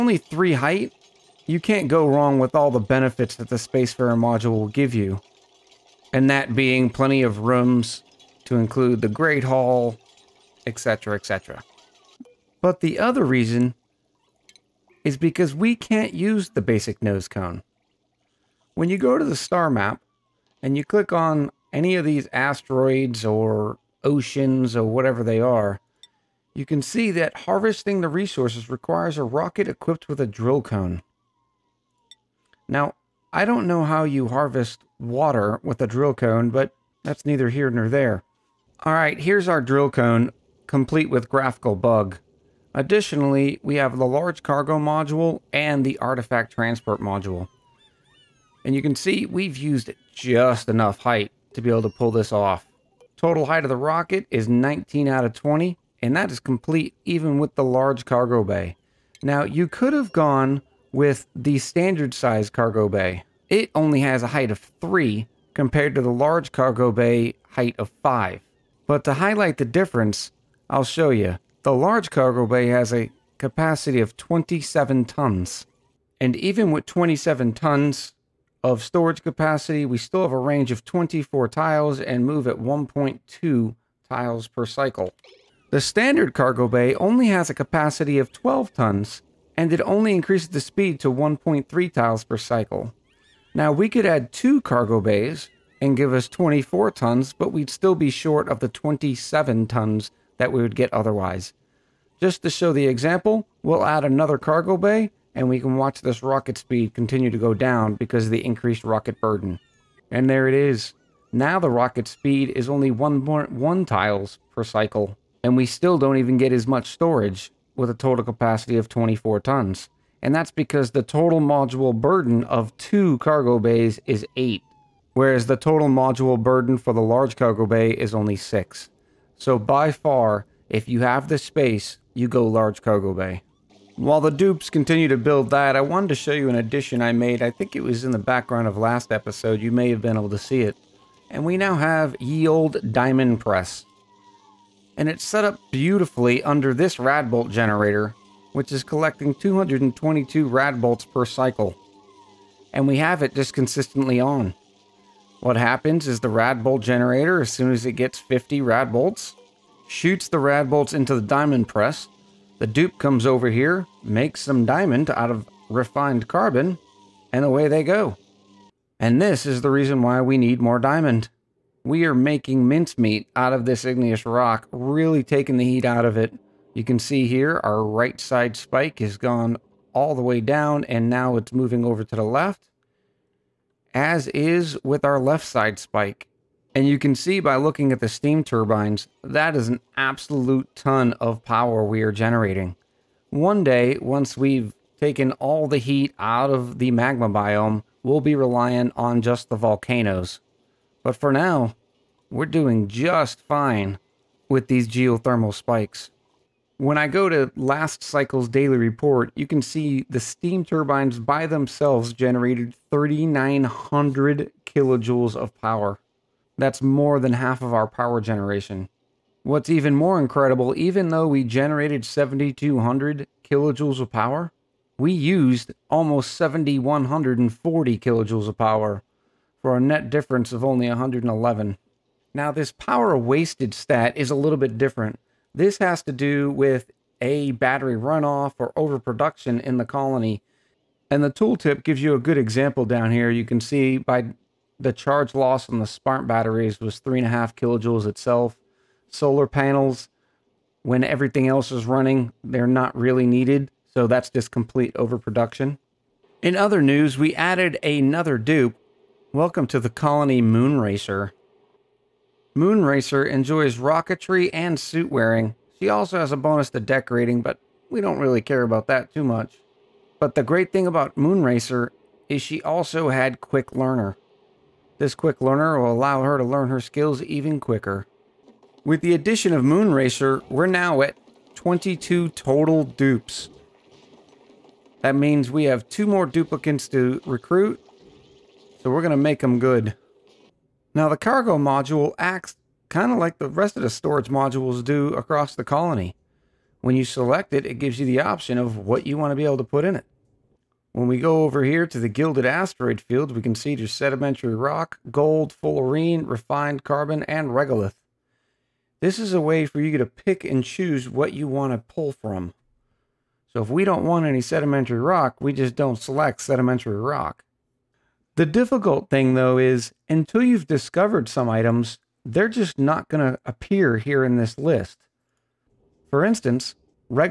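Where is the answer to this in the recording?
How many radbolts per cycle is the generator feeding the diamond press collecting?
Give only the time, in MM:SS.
02:29.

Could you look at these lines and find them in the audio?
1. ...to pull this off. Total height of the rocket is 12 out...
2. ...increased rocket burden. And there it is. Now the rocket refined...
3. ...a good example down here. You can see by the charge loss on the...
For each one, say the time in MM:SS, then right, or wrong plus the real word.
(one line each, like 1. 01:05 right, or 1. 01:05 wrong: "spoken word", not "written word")
1. 00:51 wrong: "19", not "12"
2. 01:48 wrong: "speed", not "refined"
3. 04:02 right.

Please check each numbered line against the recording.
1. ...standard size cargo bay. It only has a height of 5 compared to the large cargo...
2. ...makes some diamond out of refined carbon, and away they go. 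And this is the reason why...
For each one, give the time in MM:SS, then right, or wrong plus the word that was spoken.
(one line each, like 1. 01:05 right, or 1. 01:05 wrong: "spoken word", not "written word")
1. 01:01 wrong: "3", not "5"
2. 02:44 right.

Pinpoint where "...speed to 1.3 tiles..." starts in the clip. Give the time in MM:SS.
01:30.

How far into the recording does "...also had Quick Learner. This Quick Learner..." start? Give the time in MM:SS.
04:32.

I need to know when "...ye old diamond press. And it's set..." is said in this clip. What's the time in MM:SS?
02:22.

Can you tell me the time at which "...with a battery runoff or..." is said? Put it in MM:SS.
03:56.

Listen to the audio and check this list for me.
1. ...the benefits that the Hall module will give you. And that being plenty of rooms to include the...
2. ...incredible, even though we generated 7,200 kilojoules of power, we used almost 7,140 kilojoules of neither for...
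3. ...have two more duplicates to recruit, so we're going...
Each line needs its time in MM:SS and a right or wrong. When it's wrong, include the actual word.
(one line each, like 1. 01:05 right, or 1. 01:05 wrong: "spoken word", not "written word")
1. 00:02 wrong: "Spacefarer", not "Hall"
2. 03:40 wrong: "power", not "neither"
3. 04:45 right.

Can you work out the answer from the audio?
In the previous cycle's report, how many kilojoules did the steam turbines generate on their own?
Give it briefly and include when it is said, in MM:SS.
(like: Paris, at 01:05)
3,900, at 03:32.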